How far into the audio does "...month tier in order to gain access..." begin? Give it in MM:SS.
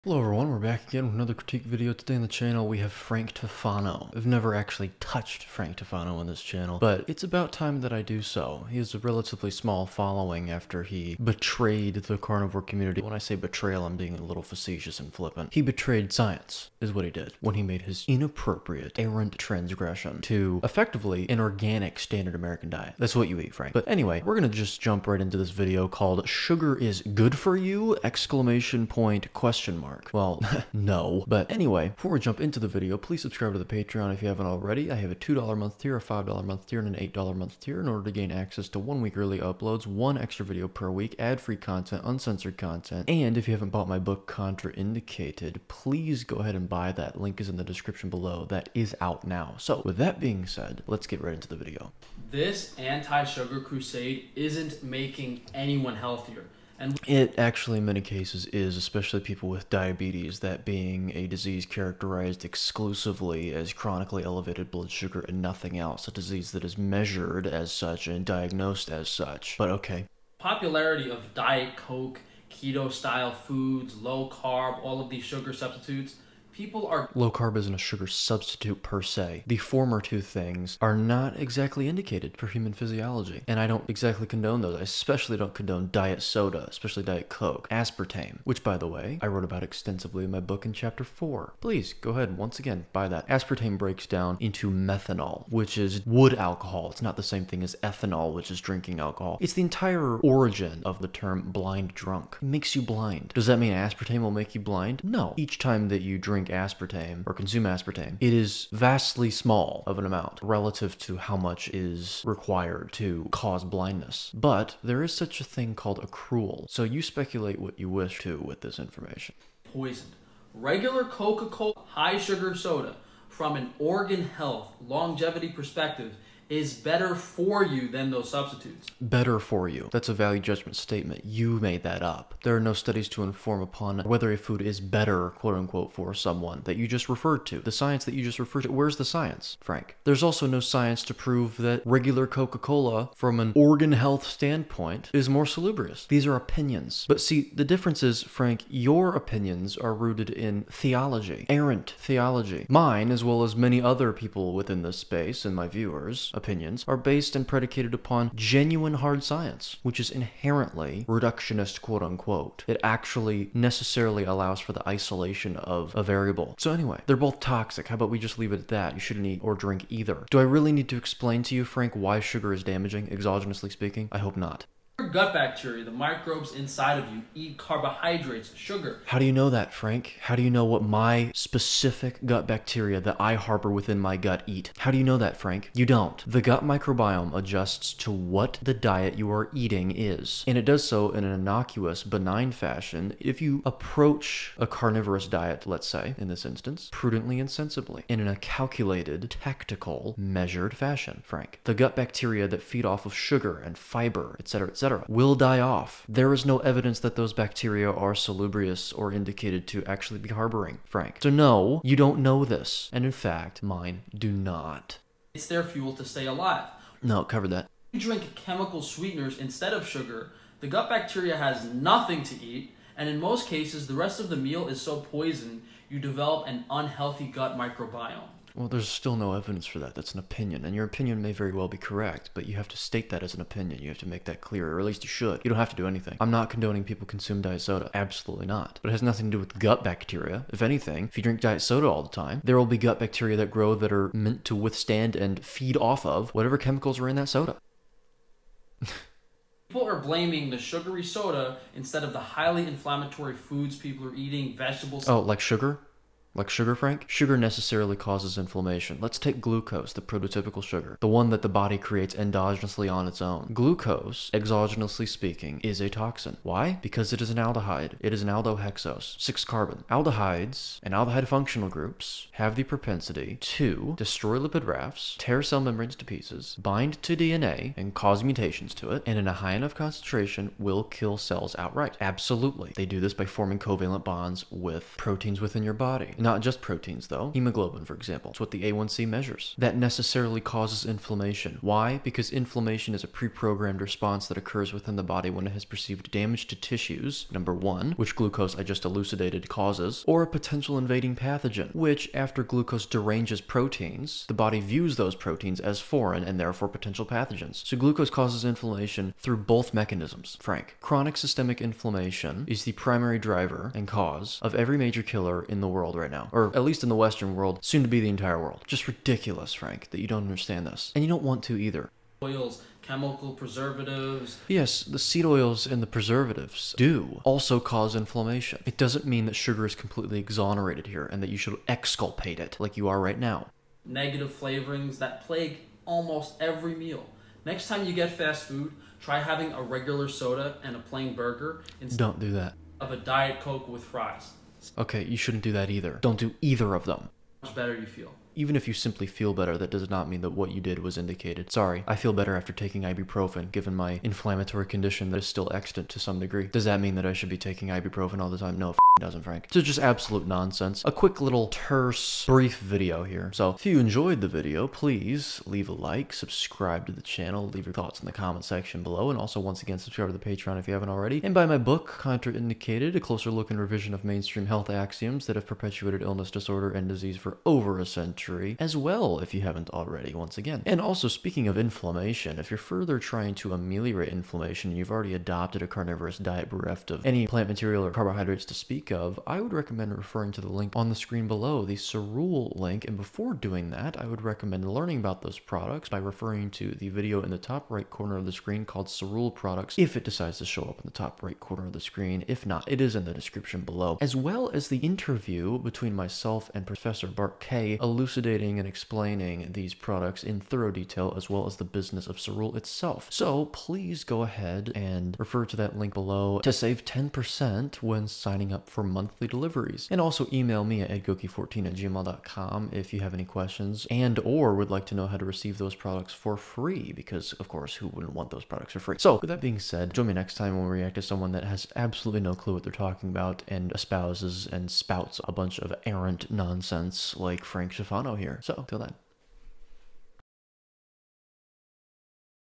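00:37.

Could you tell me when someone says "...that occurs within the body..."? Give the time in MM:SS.
04:54.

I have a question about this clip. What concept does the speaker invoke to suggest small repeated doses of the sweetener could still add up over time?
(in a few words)
accrual.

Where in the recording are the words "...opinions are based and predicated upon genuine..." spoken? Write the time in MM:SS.
02:36.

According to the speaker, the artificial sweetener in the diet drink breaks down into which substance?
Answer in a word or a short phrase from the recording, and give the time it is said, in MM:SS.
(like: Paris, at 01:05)
methanol, at 01:34.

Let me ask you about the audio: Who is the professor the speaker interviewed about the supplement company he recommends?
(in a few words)
Bart Kay.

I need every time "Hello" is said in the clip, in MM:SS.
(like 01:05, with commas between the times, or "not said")
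00:00.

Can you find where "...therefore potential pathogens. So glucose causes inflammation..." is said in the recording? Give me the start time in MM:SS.
05:06.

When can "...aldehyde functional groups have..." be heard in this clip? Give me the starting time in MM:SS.
04:30.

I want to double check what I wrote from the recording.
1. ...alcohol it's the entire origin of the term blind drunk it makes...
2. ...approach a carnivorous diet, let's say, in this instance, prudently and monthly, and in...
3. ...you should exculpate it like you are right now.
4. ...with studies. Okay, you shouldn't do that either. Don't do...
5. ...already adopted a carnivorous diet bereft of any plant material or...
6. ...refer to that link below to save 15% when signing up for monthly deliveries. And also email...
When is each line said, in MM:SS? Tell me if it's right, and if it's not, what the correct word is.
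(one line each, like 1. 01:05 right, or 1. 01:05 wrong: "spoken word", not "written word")
1. 01:38 right
2. 03:13 wrong: "sensibly", not "monthly"
3. 05:31 right
4. 05:43 wrong: "fries", not "studies"
5. 06:24 right
6. 06:55 wrong: "10", not "15".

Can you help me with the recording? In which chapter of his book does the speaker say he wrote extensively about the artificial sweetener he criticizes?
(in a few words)
chapter 4.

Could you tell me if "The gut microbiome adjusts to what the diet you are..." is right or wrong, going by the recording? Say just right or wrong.
right.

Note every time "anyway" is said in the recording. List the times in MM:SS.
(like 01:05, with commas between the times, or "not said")
00:23, 00:31, 02:46.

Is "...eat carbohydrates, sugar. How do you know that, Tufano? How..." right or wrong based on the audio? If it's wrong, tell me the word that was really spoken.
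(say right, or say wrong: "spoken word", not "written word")
wrong: "Frank", not "Tufano".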